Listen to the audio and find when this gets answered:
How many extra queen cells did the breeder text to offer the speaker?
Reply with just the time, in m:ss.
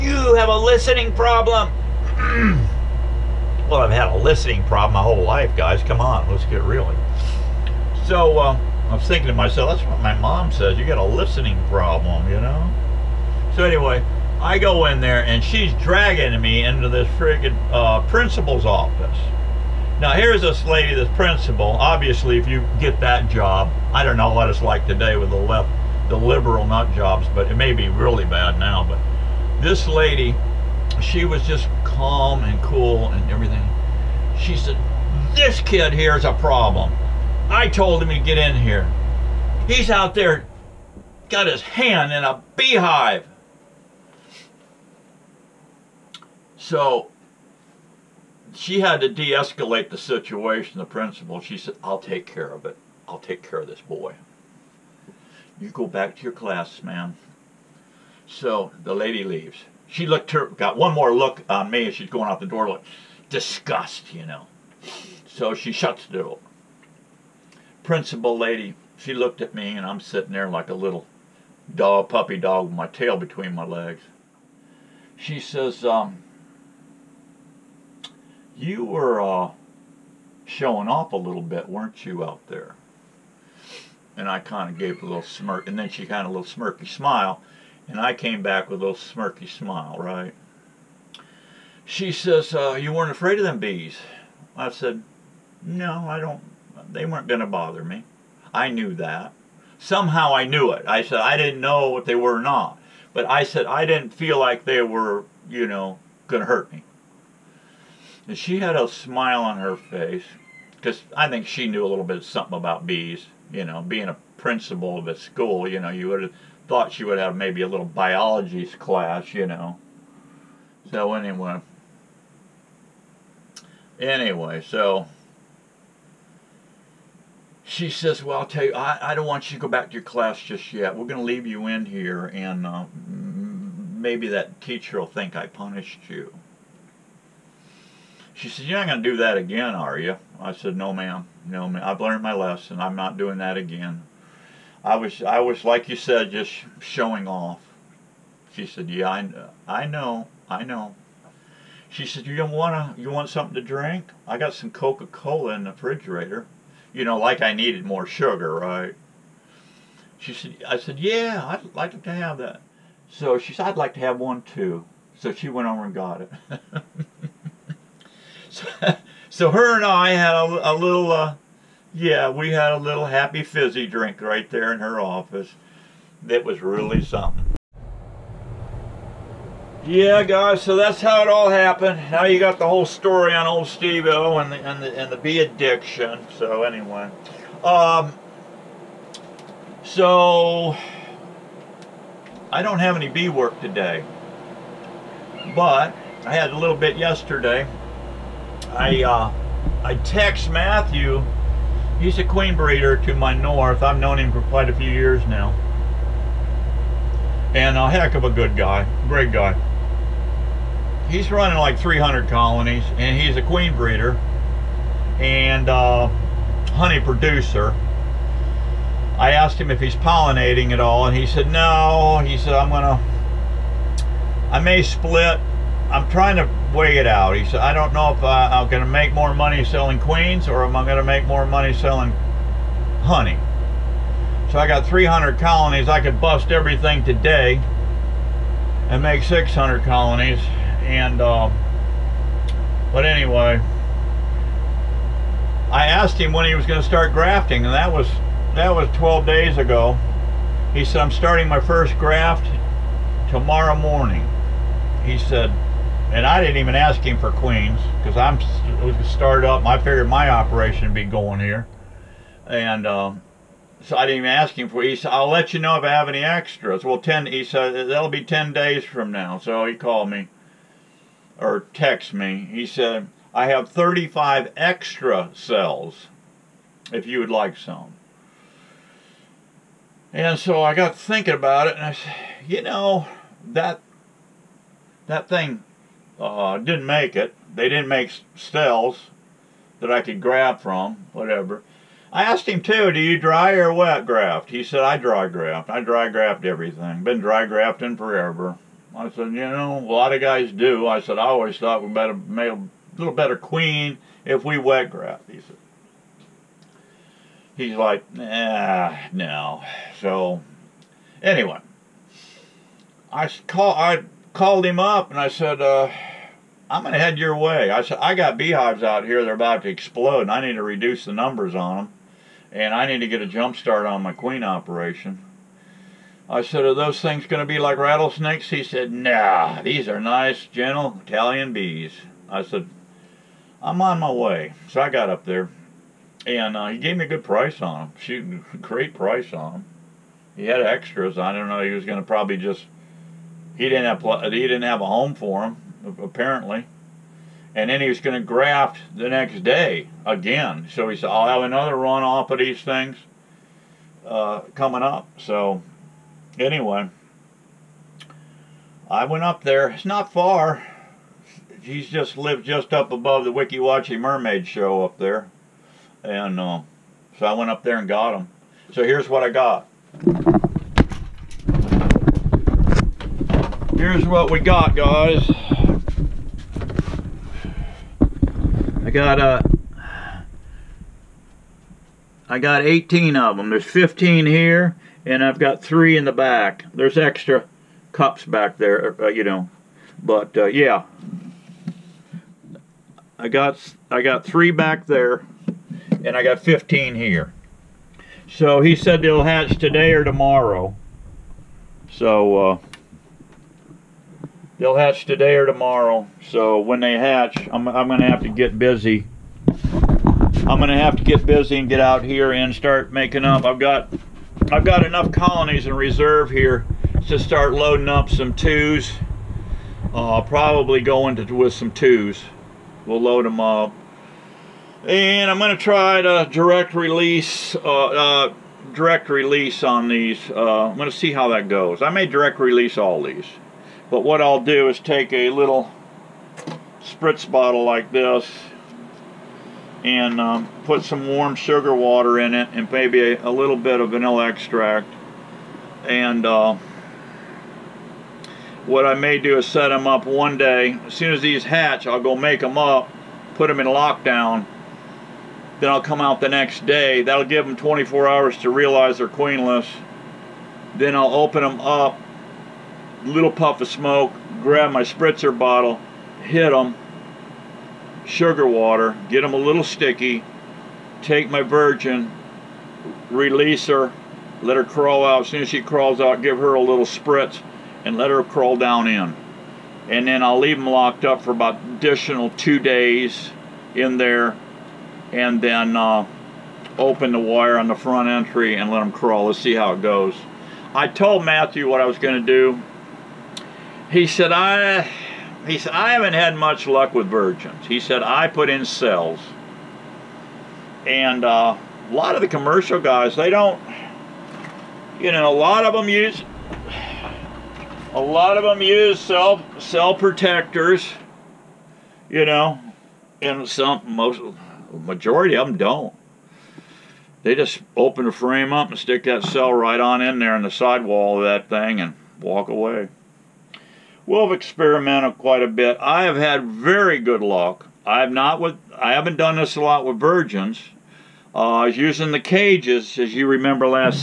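4:33.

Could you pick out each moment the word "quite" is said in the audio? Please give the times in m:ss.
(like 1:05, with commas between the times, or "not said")
3:24, 8:45.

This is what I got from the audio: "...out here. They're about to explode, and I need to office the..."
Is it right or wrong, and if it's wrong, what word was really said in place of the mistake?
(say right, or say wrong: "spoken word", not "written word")
wrong: "reduce", not "office".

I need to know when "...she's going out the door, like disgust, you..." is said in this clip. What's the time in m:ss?
1:01.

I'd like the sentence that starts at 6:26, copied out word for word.
There's extra cups back there, uh, uh you know.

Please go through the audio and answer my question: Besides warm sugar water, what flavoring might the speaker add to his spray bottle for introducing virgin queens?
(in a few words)
Vanilla extract.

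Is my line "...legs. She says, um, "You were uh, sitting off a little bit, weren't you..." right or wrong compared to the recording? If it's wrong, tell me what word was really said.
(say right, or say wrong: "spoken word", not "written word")
wrong: "showing", not "sitting".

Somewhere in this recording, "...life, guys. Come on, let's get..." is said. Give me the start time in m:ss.
0:05.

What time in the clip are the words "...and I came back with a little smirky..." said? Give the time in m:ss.
1:27.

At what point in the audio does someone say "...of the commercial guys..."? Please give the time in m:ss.
8:22.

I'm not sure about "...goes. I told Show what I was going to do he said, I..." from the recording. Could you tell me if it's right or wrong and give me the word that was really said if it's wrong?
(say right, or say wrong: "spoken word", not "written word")
wrong: "Matthew", not "Show".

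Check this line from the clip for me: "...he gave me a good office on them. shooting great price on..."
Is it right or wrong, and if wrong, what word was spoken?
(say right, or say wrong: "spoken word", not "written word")
wrong: "price", not "office".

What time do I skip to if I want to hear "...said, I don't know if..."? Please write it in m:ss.
3:47.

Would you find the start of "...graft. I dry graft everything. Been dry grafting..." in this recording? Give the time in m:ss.
4:55.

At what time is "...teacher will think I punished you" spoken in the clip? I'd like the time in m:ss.
2:14.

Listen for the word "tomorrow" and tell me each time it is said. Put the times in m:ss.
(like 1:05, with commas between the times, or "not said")
4:13, 6:40, 6:45.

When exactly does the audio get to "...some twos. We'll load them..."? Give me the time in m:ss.
7:01.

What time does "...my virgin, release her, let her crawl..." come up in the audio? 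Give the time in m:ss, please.
7:51.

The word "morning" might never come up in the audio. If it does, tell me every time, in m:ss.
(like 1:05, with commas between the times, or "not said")
4:13.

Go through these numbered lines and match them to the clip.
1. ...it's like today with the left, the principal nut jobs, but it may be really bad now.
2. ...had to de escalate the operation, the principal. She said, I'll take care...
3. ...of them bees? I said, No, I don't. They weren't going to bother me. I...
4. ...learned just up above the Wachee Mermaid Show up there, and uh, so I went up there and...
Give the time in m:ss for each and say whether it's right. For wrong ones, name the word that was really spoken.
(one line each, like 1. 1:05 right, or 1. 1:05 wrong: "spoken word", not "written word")
1. 0:24 wrong: "liberal", not "principal"
2. 0:48 wrong: "situation", not "operation"
3. 1:33 right
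4. 6:02 wrong: "lived", not "learned".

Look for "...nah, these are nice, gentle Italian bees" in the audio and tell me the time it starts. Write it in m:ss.
5:28.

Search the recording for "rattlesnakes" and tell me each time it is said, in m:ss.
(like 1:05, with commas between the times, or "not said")
5:27.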